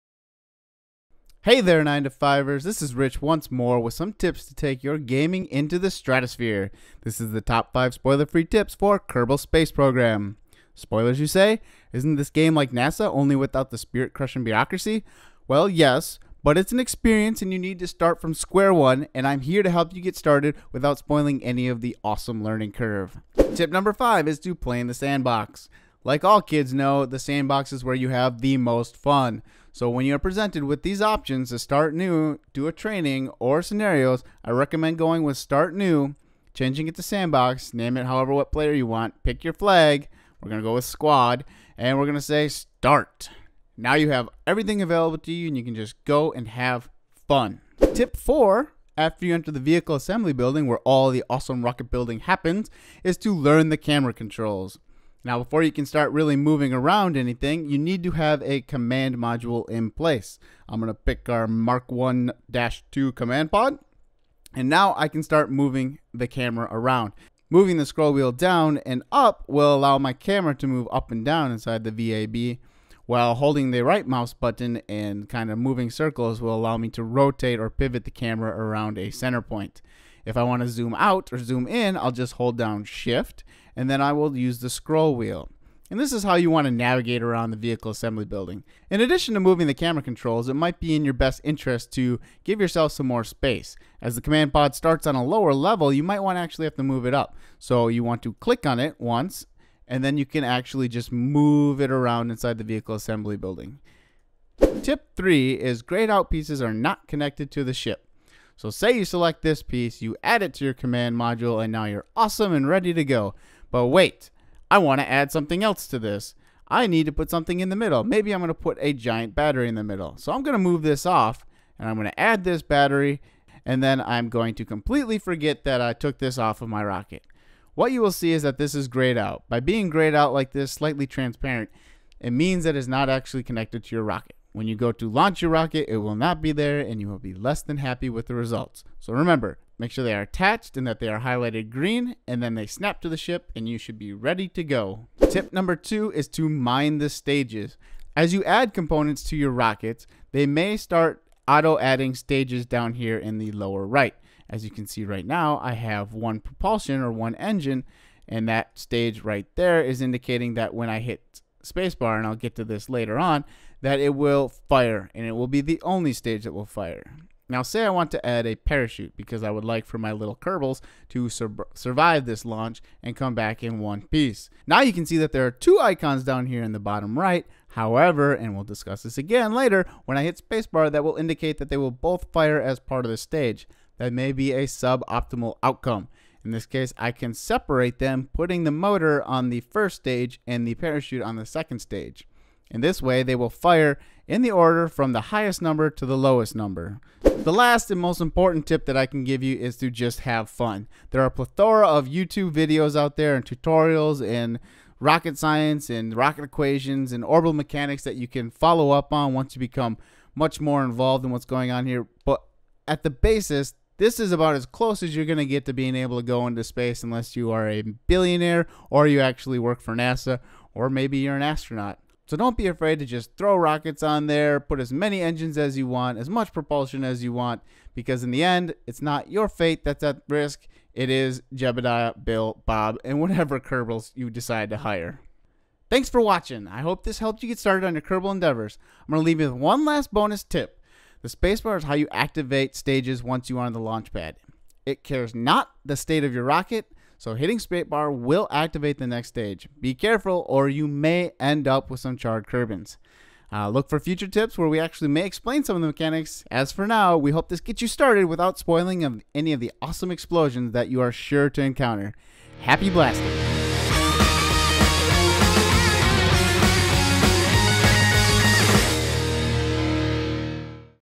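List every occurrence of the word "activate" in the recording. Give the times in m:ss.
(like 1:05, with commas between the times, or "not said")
4:02, 4:08.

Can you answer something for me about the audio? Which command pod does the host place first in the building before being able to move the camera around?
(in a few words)
Mark 1-2 command pod.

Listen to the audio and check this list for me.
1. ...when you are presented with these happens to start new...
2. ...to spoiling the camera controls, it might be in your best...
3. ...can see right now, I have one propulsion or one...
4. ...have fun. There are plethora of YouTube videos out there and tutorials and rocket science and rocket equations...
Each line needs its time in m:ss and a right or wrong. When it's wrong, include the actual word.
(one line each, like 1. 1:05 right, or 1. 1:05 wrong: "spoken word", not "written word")
1. 0:29 wrong: "options", not "happens"
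2. 1:29 wrong: "moving", not "spoiling"
3. 2:34 right
4. 3:20 right.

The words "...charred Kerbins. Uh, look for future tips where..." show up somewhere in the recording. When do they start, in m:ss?
4:12.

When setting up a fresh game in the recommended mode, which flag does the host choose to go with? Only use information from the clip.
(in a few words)
Squad.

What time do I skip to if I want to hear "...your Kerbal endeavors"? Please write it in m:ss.
3:57.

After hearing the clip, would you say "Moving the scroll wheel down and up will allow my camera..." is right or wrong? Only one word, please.
right.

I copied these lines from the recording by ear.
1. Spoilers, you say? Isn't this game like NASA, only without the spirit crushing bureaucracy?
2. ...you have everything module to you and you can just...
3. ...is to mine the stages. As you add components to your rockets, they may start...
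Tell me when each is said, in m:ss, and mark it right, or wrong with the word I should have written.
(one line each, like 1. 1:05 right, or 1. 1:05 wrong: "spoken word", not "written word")
1. 0:10 right
2. 0:43 wrong: "available", not "module"
3. 2:26 right.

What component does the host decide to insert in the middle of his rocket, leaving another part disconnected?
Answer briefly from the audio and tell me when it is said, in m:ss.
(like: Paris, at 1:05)
A giant battery, at 1:58.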